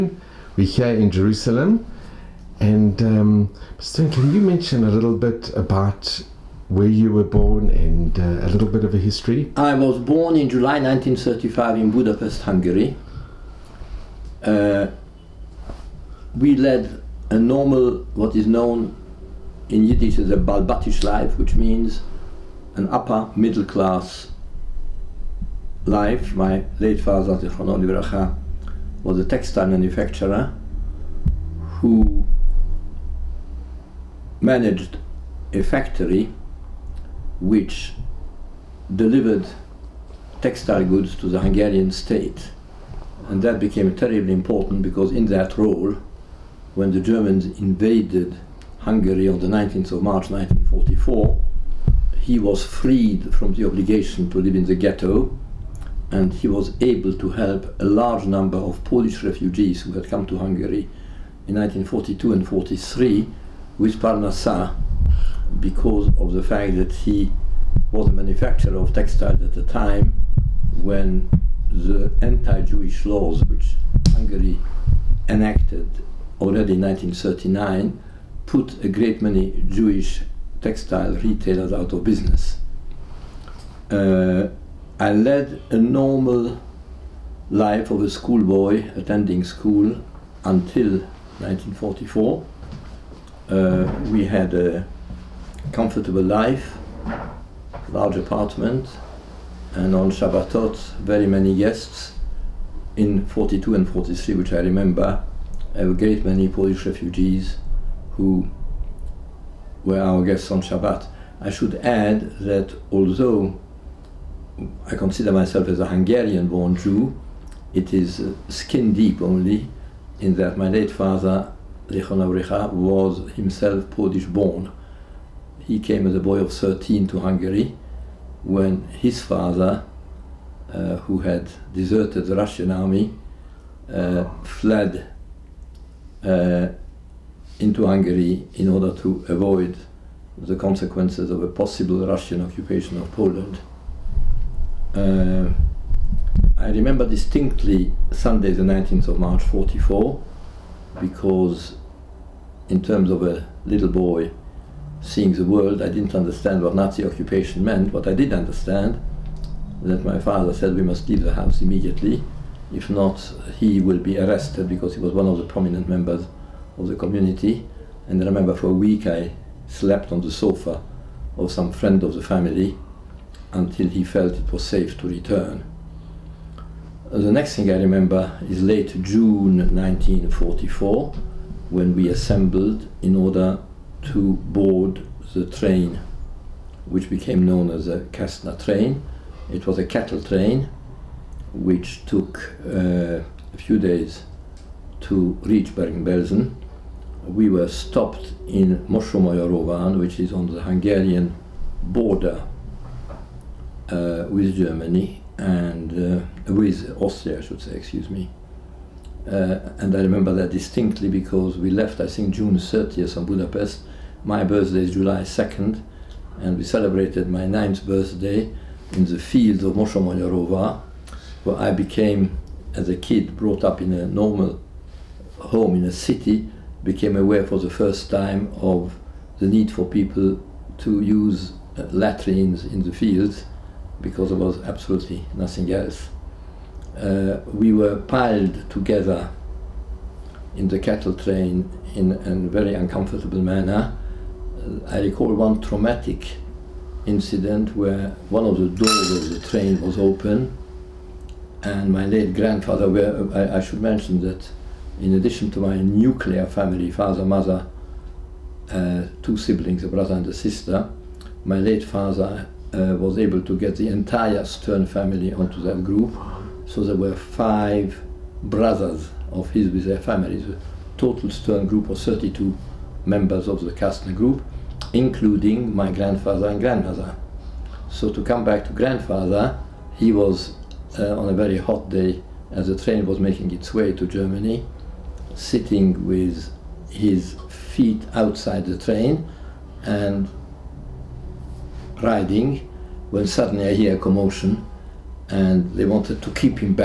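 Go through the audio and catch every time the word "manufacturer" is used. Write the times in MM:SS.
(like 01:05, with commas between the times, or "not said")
00:29, 01:08.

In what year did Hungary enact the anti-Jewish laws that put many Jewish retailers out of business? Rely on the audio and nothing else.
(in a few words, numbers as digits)
1939.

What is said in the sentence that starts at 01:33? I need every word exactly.
Uh, we had a comfortable life, large apartment, and on Shabbatot, very many guests.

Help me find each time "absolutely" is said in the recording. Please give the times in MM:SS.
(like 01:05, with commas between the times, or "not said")
03:54.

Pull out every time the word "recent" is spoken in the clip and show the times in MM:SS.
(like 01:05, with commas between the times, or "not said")
not said.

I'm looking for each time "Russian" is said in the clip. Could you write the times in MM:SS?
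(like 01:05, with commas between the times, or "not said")
02:12, 02:22.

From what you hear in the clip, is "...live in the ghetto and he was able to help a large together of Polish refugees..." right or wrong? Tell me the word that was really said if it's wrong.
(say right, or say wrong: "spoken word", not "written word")
wrong: "number", not "together".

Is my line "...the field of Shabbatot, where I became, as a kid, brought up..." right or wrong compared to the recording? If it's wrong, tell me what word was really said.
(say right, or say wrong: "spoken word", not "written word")
wrong: "Mosonmagyaróvár", not "Shabbatot".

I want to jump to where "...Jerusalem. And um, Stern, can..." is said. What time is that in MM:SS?
00:01.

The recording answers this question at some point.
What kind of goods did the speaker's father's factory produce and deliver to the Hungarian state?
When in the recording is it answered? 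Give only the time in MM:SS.
00:40.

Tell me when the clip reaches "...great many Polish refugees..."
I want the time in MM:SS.
01:45.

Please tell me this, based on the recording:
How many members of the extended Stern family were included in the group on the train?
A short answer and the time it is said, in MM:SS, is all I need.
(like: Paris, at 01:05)
32, at 04:31.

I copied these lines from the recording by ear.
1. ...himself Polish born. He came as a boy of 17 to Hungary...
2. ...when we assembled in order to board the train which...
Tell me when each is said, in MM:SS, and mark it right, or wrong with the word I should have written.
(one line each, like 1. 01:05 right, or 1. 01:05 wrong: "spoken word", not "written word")
1. 02:03 wrong: "13", not "17"
2. 03:01 right.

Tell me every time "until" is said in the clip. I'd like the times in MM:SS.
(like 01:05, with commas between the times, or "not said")
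01:30, 02:53.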